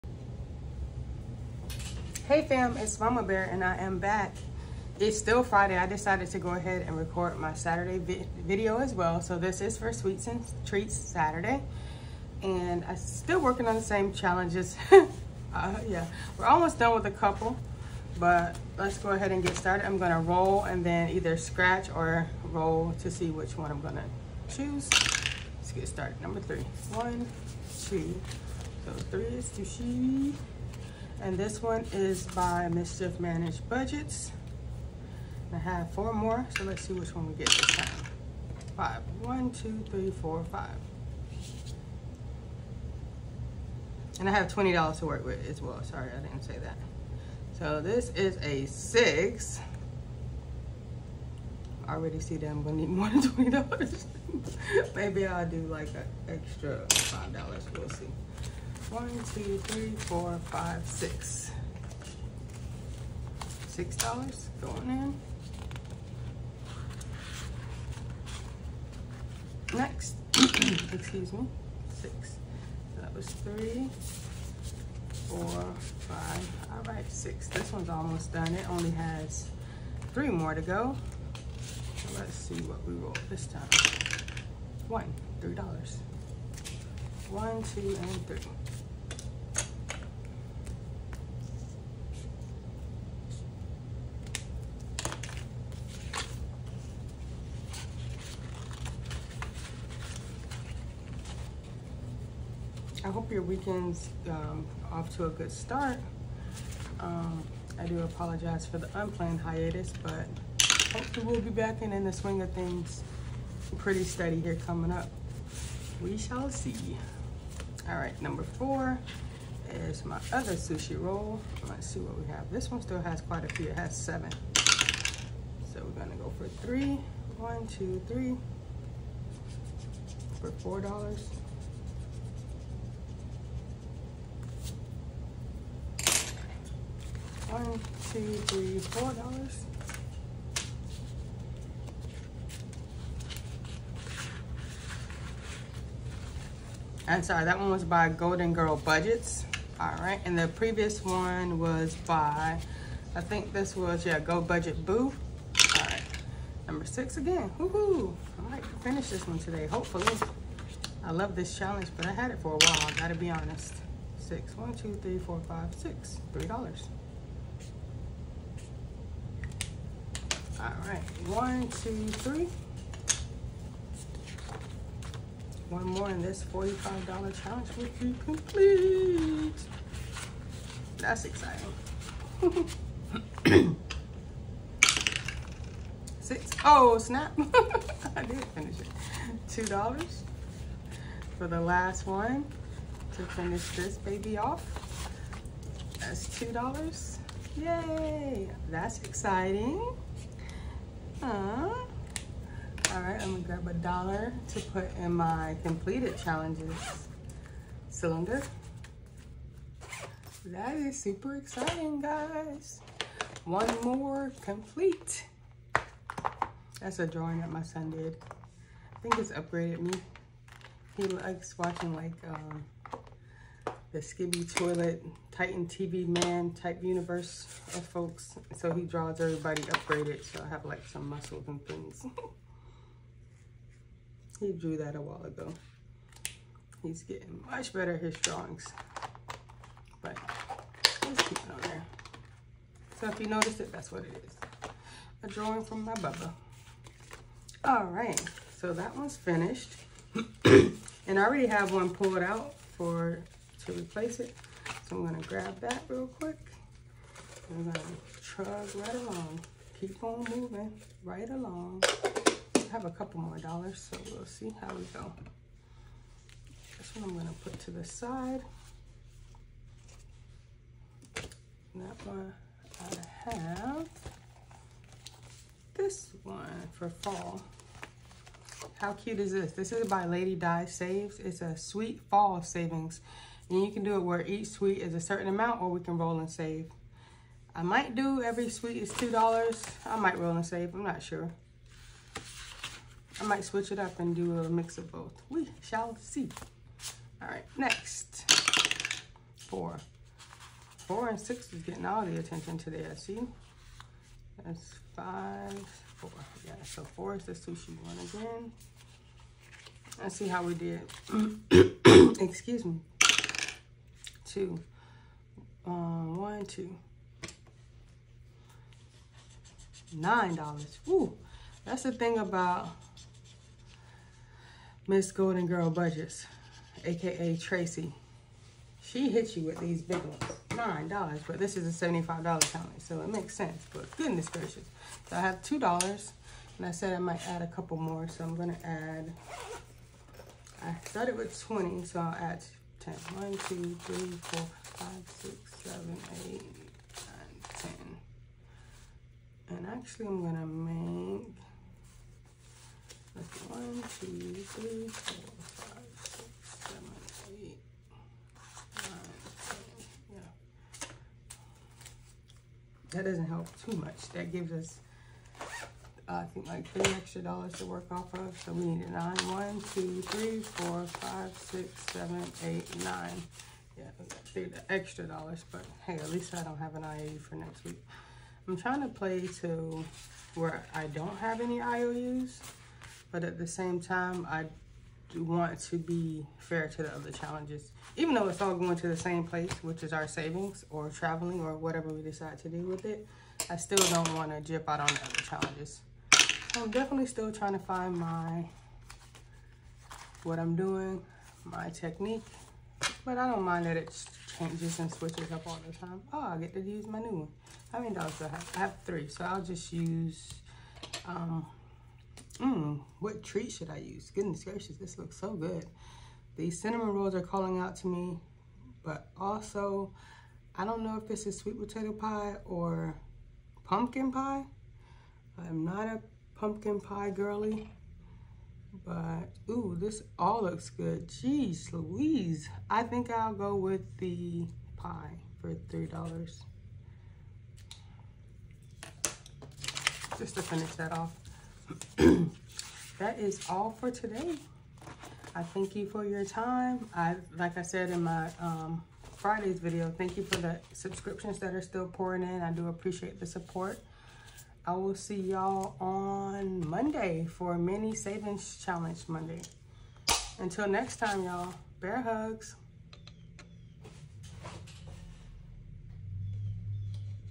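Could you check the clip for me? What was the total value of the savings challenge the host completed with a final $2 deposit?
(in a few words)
$45.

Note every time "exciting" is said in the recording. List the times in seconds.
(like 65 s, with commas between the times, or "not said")
181 s, 199 s, 211 s.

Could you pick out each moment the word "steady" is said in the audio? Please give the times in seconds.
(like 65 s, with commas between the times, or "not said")
114 s.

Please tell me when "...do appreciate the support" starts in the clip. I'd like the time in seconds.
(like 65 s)
452 s.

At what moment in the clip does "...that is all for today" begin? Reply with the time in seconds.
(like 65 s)
442 s.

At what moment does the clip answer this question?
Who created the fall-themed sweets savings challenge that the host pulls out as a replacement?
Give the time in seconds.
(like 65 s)
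280 s.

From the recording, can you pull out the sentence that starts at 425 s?
I'm not a pumpkin pie girly.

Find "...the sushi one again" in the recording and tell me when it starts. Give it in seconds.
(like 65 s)
307 s.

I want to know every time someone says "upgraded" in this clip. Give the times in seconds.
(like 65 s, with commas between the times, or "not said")
219 s, 229 s.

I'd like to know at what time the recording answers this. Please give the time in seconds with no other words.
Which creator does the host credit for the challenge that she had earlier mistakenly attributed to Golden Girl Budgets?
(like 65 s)
154 s.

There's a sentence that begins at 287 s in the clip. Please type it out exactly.
I might do every sweet is $2.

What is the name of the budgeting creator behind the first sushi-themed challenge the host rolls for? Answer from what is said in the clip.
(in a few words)
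Mischief Managed Budgets.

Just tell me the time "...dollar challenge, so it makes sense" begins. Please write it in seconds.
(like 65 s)
332 s.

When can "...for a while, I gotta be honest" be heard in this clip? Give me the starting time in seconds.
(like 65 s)
162 s.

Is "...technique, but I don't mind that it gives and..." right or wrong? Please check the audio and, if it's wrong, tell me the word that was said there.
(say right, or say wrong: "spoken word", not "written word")
wrong: "changes", not "gives".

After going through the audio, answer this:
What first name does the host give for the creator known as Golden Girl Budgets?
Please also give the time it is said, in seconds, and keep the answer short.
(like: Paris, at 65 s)
Tracy, at 327 s.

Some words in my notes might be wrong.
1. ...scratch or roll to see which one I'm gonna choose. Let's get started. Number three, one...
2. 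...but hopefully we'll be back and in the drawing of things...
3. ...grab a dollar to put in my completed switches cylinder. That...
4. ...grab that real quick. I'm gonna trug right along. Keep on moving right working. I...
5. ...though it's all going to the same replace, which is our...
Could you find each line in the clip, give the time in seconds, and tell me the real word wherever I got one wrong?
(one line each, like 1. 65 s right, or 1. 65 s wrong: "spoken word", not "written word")
1. 21 s right
2. 110 s wrong: "swing", not "drawing"
3. 203 s wrong: "challenges", not "switches"
4. 255 s wrong: "along", not "working"
5. 388 s wrong: "place", not "replace".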